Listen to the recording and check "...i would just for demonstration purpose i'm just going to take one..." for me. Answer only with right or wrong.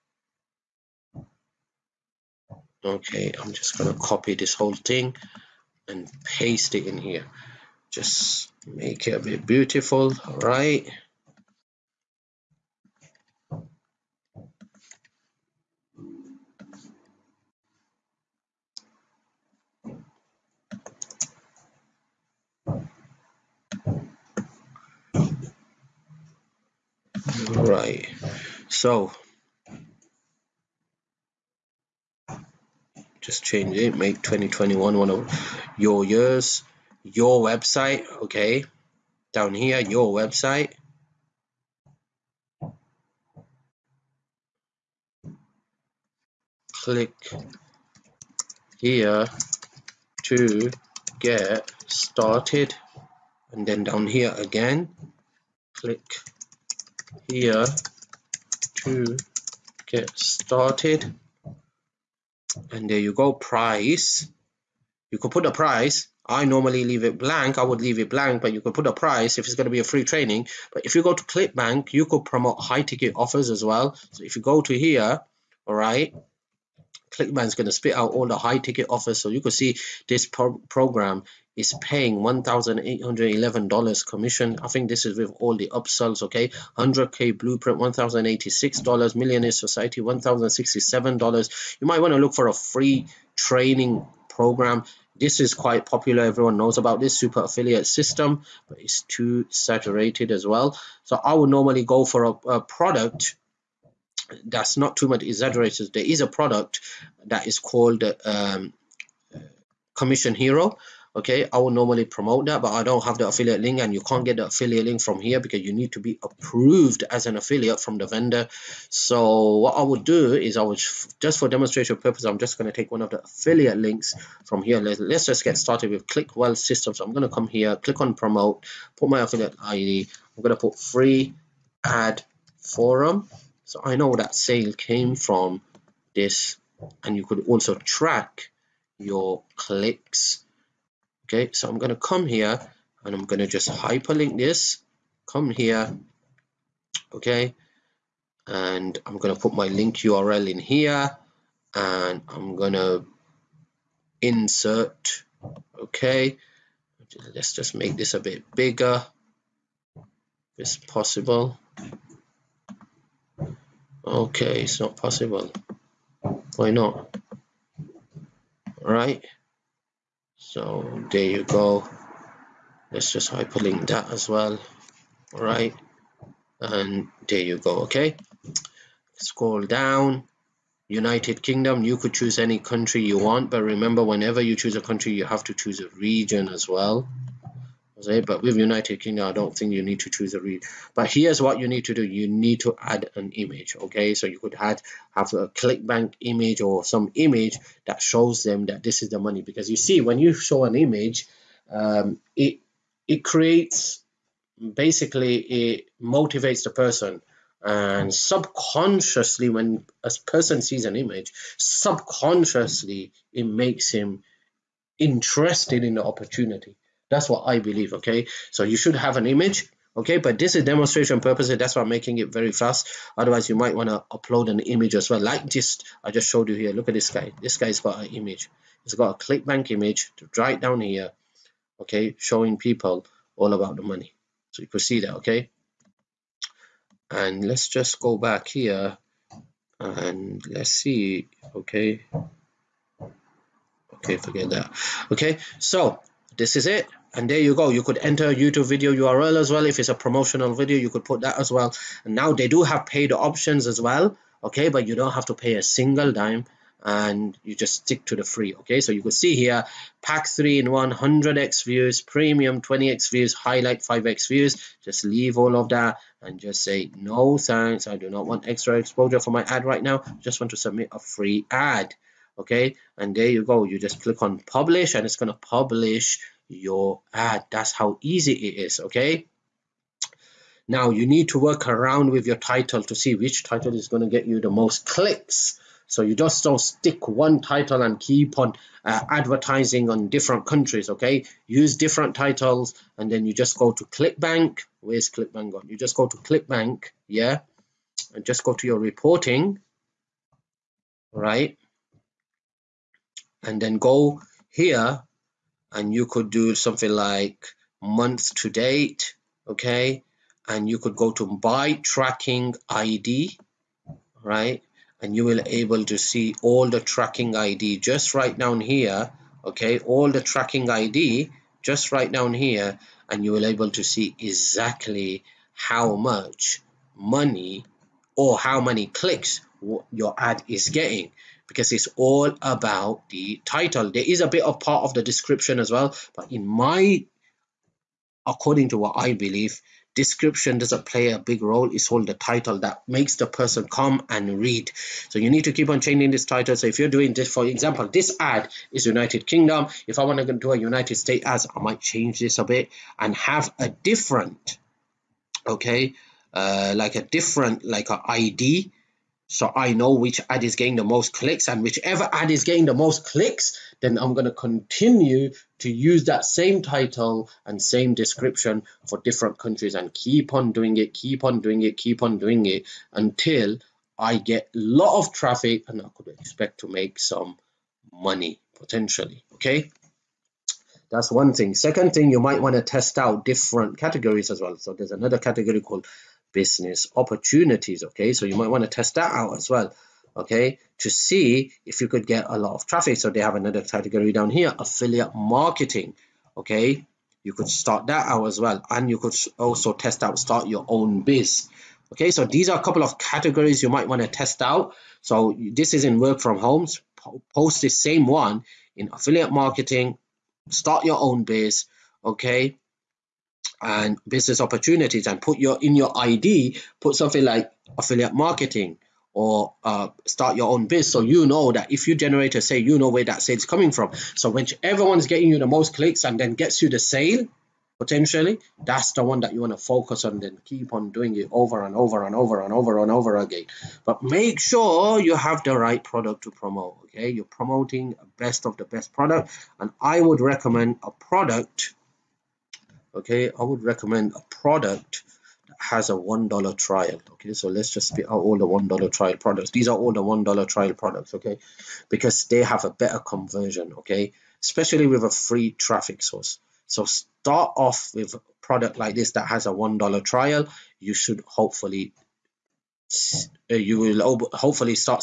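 right.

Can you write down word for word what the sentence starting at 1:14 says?
So if you go to here, all right, ClickBank is going to spit out all the high ticket offers.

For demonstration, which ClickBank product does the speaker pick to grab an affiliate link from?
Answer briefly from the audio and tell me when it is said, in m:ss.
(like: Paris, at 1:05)
Click Wealth Systems, at 2:06.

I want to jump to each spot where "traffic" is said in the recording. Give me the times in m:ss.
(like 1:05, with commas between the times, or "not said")
6:15, 6:32, 7:35.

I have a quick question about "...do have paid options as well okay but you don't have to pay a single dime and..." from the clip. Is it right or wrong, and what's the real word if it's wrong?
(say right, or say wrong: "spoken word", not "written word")
right.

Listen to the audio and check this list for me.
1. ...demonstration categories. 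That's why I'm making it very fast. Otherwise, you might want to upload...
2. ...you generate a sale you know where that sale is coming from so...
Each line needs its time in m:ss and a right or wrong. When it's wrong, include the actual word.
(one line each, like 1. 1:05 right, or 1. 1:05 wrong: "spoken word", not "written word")
1. 3:40 wrong: "purposes", not "categories"
2. 7:01 right.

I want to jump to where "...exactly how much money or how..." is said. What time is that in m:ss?
5:24.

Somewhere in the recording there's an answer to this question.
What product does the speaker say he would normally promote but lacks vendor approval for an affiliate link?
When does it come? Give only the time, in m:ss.
1:49.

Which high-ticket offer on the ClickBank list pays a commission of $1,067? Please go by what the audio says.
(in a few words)
Millionaire Society.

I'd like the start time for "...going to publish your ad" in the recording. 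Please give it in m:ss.
4:35.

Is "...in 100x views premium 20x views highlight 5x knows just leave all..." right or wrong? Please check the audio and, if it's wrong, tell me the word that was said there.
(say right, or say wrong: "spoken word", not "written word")
wrong: "views", not "knows".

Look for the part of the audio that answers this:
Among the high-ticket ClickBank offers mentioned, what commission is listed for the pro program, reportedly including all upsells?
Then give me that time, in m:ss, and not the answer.
1:22.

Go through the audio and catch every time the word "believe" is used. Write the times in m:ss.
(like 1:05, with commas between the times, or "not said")
3:37, 5:39.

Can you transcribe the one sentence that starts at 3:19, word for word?
Because you see, when you show an image, um, it, it creates, basically, it motivates the person.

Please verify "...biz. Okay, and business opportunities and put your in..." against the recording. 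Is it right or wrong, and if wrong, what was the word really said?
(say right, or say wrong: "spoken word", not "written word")
right.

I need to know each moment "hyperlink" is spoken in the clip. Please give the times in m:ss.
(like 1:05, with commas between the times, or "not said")
2:23, 2:53.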